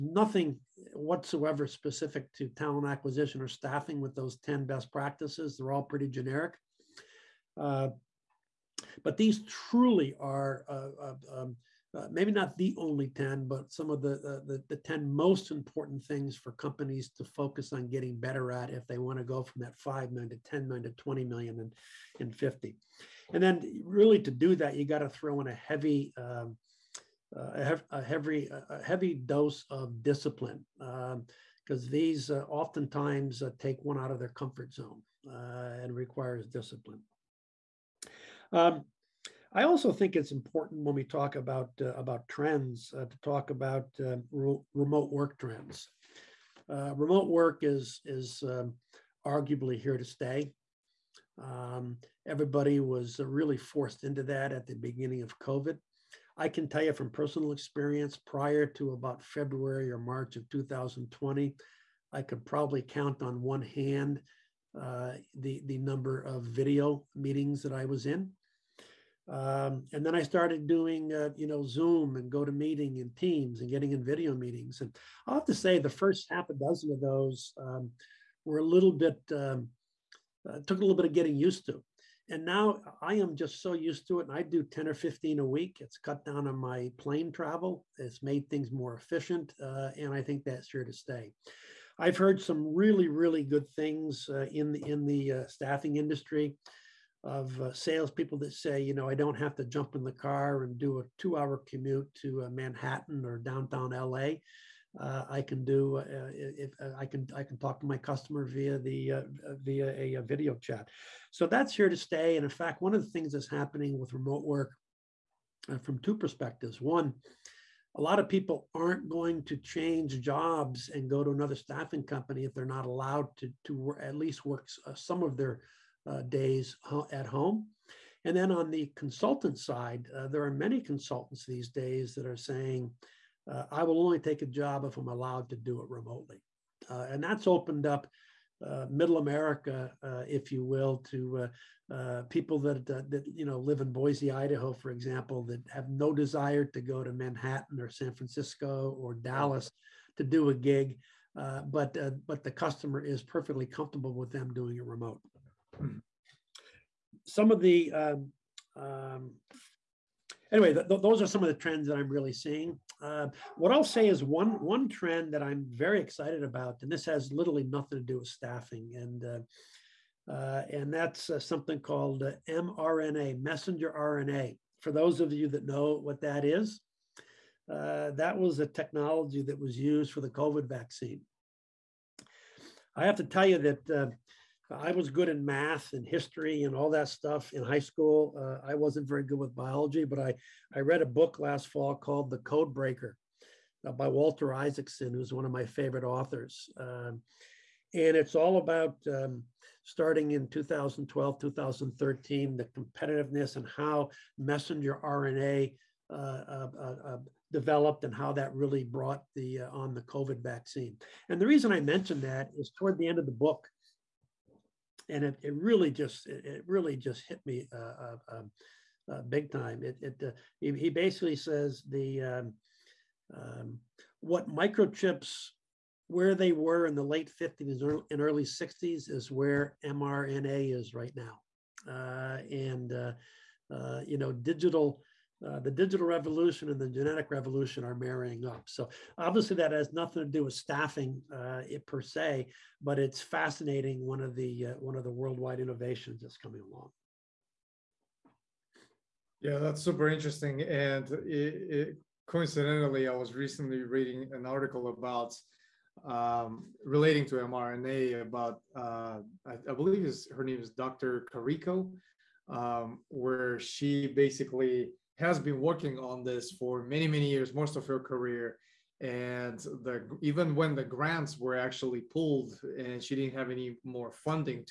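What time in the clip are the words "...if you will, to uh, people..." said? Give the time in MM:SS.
02:20.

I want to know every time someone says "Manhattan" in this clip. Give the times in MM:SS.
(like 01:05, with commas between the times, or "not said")
01:42, 02:27.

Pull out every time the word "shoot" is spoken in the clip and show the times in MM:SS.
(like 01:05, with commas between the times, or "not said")
not said.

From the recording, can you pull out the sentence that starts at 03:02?
I have to tell you that I was good in math and history and all that stuff in high school.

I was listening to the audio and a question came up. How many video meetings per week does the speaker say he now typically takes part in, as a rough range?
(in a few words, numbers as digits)
10 or 15.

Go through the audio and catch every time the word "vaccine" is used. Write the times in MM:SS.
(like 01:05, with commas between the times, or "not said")
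03:00, 03:30.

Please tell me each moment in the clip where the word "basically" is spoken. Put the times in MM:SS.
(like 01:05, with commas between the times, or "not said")
03:40, 04:24.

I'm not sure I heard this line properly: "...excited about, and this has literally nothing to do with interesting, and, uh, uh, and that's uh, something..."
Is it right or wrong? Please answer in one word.
wrong.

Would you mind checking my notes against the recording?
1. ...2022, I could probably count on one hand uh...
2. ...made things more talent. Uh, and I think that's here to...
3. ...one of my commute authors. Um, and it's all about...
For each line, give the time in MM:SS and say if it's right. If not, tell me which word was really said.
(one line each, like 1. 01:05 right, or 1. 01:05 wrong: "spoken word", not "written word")
1. 01:00 wrong: "2020", not "2022"
2. 01:28 wrong: "efficient", not "talent"
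3. 03:15 wrong: "favorite", not "commute".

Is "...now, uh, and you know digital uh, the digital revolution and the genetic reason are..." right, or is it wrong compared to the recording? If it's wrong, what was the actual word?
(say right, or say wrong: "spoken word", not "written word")
wrong: "revolution", not "reason".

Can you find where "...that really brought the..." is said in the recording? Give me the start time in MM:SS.
03:28.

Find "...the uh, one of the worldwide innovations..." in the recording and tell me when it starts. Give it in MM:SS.
04:04.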